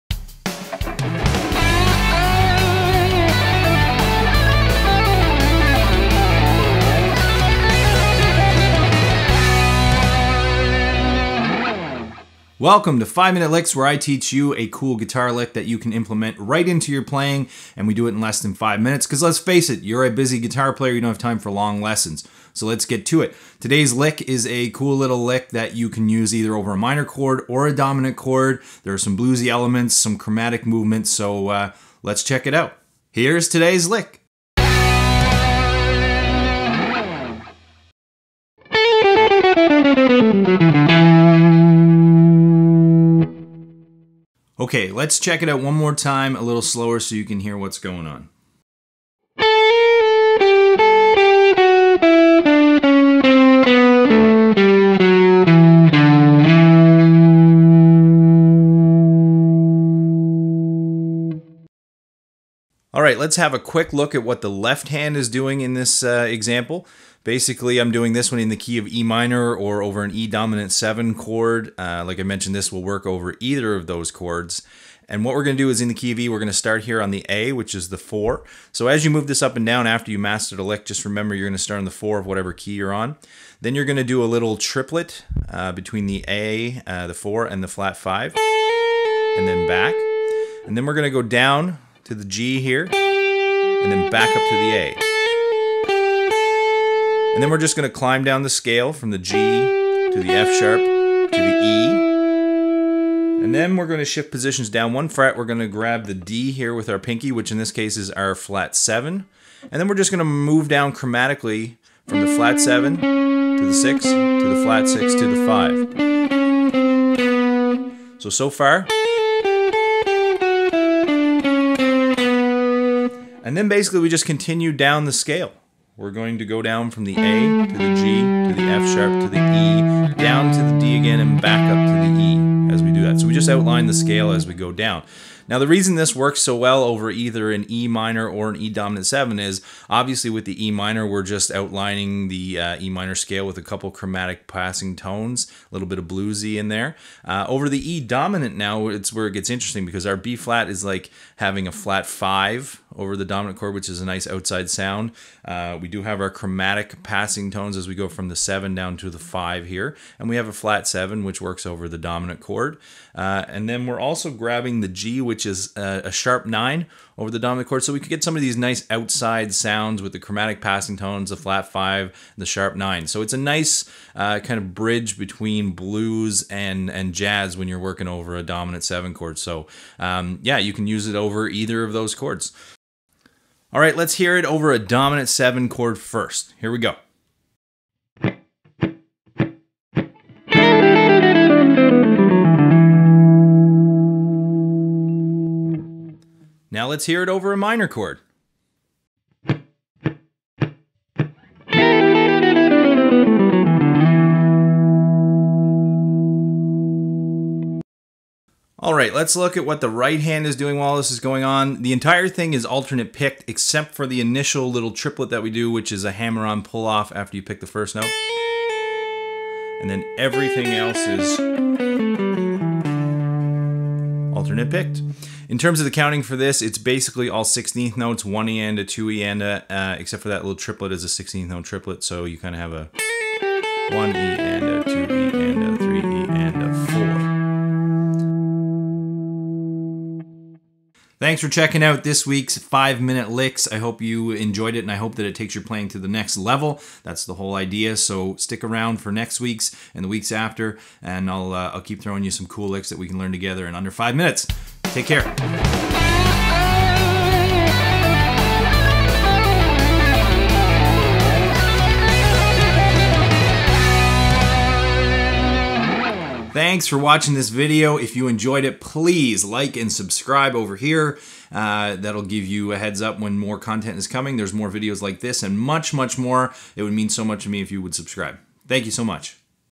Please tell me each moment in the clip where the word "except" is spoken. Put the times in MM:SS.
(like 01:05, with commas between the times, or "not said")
03:33, 03:49.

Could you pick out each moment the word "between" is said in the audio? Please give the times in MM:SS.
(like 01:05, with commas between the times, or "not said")
01:25, 02:55.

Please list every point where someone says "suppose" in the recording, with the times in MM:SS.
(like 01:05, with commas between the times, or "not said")
not said.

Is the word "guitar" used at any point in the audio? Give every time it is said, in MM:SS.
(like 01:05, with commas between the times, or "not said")
00:14, 00:20.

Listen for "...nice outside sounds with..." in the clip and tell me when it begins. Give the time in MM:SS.
02:48.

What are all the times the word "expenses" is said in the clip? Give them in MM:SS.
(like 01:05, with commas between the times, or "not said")
not said.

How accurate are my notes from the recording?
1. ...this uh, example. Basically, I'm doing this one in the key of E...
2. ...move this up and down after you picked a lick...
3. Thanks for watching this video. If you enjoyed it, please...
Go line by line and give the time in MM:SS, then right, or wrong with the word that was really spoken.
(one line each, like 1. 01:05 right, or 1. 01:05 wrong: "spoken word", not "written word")
1. 01:05 right
2. 01:19 wrong: "mastered", not "picked"
3. 04:26 right.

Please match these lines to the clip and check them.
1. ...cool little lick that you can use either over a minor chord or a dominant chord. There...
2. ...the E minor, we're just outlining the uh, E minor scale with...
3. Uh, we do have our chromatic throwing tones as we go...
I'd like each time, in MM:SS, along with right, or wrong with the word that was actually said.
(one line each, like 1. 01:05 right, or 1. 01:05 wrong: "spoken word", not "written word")
1. 00:24 right
2. 02:20 right
3. 02:35 wrong: "passing", not "throwing".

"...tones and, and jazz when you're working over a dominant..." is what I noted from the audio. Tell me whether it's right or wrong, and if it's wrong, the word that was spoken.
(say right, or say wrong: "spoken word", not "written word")
wrong: "blues", not "tones".